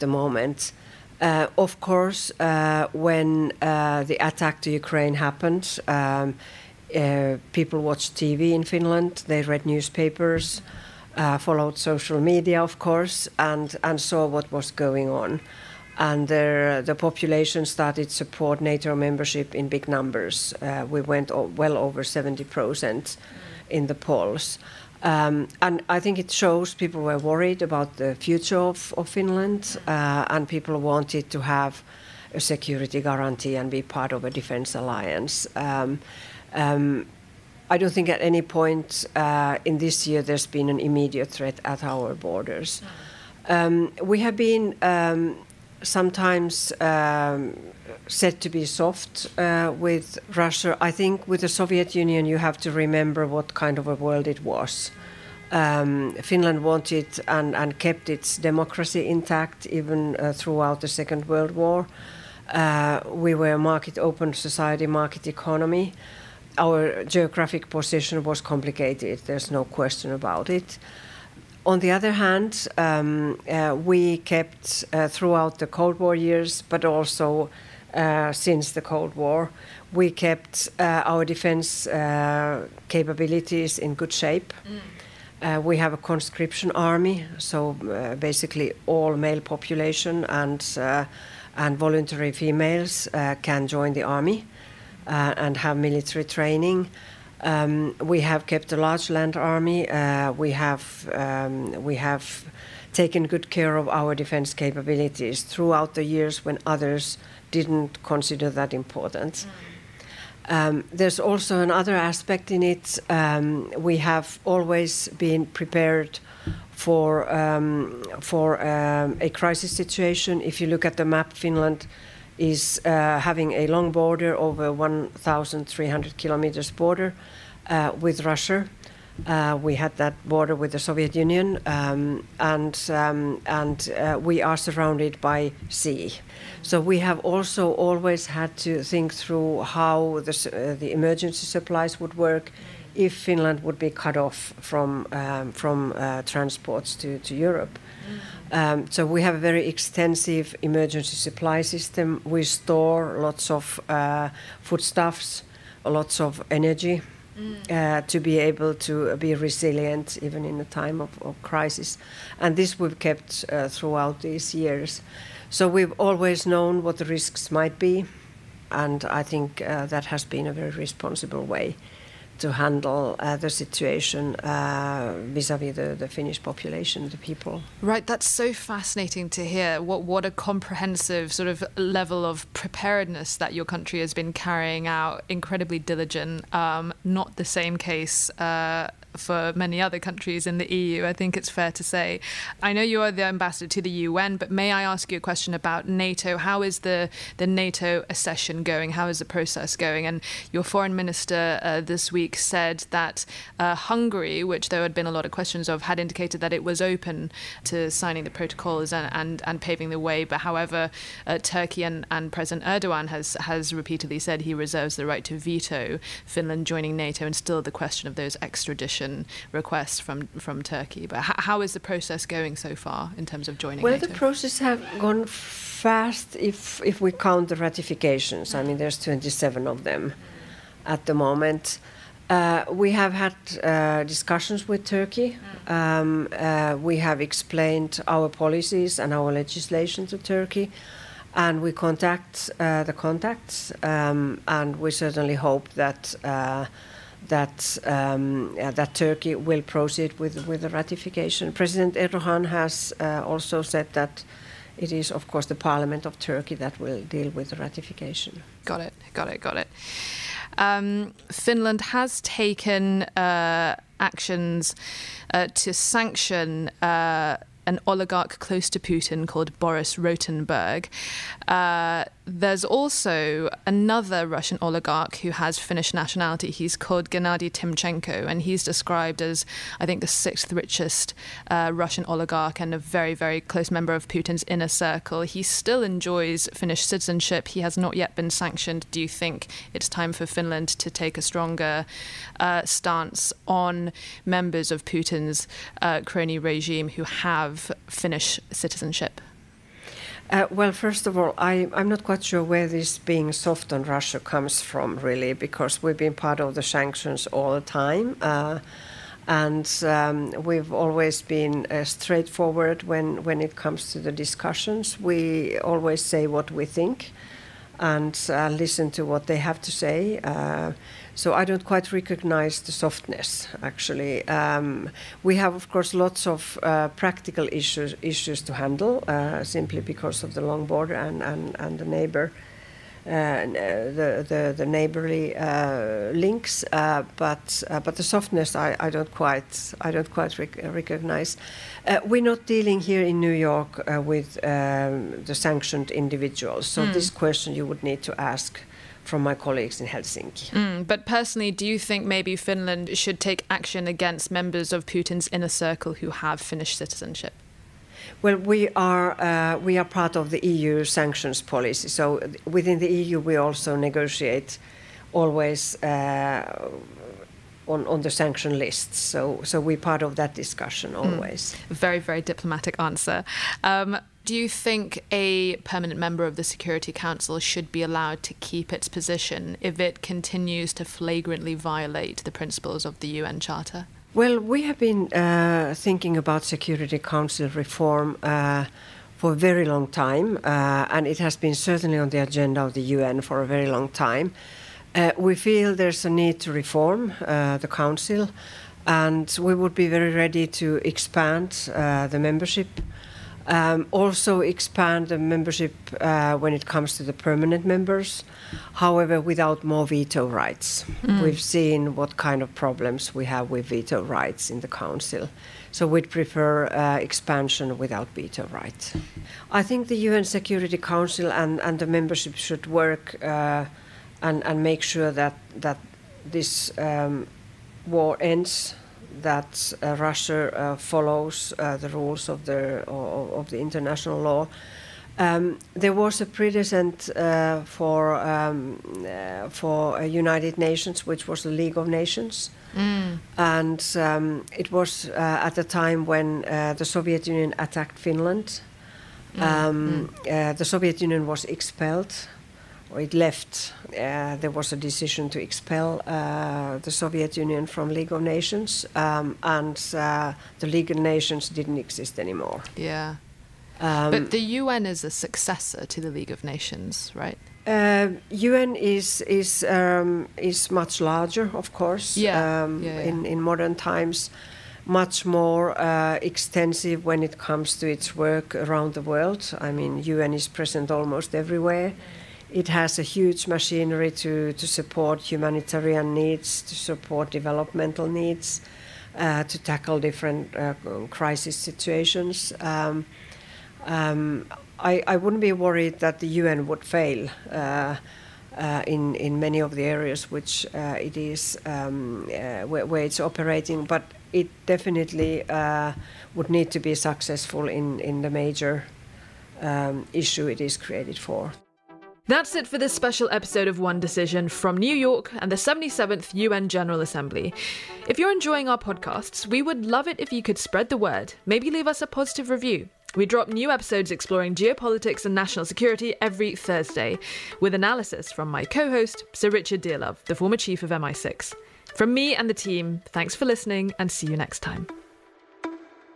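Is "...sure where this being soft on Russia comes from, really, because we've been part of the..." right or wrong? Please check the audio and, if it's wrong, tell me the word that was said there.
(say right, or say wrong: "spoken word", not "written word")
right.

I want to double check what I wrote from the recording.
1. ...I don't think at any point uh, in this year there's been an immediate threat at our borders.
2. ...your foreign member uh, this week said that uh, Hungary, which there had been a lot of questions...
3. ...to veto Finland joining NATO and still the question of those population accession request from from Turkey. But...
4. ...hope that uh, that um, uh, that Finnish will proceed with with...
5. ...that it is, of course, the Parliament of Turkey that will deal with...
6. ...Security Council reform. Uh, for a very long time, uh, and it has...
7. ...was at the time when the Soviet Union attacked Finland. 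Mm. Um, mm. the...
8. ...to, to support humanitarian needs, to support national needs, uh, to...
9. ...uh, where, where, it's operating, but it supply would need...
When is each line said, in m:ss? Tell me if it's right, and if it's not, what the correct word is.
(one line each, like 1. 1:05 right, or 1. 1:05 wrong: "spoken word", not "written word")
1. 0:37 right
2. 3:20 wrong: "minister", not "member"
3. 3:35 wrong: "extradition", not "population"
4. 4:05 wrong: "Turkey", not "Finnish"
5. 4:13 right
6. 6:26 right
7. 7:24 right
8. 8:04 wrong: "developmental", not "national"
9. 8:22 wrong: "definitely", not "supply".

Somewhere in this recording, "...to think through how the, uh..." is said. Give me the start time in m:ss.
2:18.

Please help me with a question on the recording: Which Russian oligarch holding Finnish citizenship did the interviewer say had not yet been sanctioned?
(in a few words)
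Gennady Timchenko.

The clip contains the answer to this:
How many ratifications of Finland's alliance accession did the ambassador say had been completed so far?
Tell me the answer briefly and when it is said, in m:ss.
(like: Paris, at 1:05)
27, at 3:49.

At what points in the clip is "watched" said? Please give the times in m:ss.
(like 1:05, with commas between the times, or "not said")
0:07.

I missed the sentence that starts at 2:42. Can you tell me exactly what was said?
And this we've kept uh, throughout these years.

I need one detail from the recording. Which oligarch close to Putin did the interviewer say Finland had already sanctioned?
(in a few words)
Boris Rotenberg.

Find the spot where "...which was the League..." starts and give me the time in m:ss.
7:21.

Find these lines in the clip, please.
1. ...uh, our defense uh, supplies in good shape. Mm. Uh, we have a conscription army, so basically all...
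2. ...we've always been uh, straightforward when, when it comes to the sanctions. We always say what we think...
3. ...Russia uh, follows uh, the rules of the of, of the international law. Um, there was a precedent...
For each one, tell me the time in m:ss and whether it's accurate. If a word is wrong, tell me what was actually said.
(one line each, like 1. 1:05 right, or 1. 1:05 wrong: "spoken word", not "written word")
1. 1:20 wrong: "capabilities", not "supplies"
2. 5:10 wrong: "discussions", not "sanctions"
3. 7:09 right.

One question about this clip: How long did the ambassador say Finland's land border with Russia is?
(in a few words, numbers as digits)
over 1,300 kilometers.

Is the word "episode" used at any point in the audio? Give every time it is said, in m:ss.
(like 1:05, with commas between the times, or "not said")
8:33, 8:43.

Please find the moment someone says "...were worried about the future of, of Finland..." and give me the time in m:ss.
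0:27.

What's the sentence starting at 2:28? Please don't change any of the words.
Um, so we have a very extensive emergency supply system.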